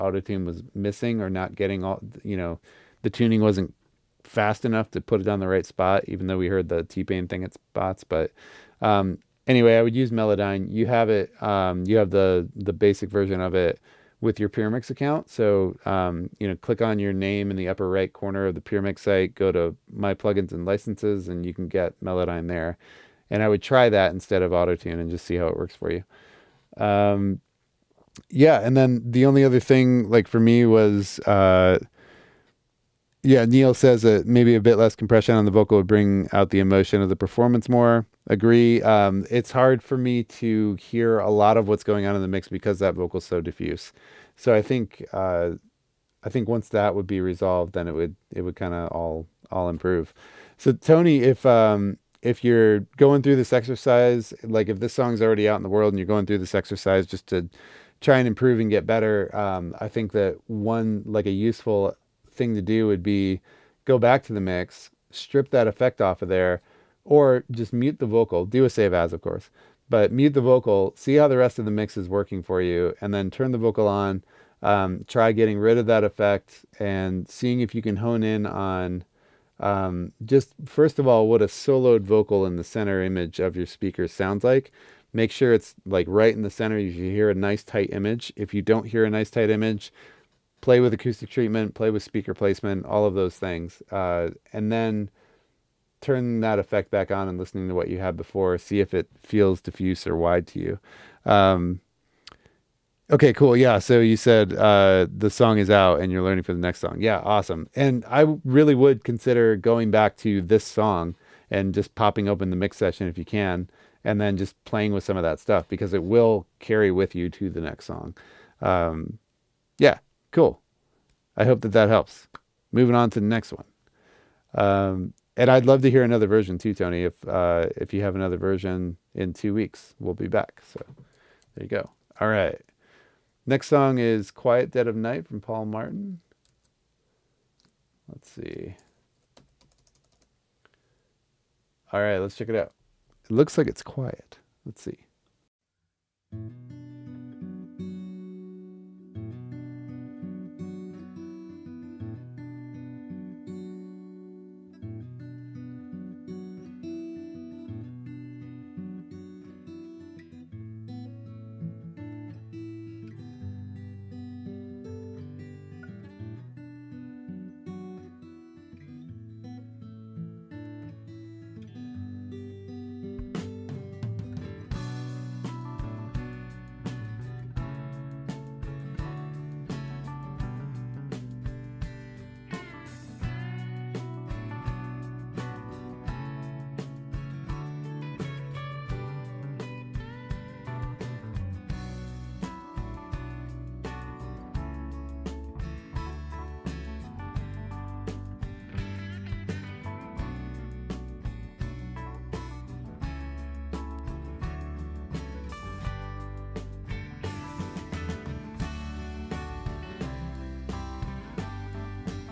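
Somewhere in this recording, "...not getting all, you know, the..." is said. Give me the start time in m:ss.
0:01.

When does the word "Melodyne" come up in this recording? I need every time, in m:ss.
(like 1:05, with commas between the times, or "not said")
0:10, 0:22.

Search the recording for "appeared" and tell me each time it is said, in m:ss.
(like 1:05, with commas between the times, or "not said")
not said.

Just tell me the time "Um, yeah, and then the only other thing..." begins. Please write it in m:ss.
0:26.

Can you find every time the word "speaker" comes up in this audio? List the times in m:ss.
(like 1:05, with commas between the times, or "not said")
1:23, 1:32.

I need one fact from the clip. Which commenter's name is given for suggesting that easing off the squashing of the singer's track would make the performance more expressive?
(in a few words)
Neil.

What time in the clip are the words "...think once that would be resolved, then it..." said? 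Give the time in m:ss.
0:46.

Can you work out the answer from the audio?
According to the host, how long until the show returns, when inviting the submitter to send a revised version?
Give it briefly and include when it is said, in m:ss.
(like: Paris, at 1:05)
2 weeks, at 2:09.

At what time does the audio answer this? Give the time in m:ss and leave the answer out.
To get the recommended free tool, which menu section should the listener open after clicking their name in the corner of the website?
0:19.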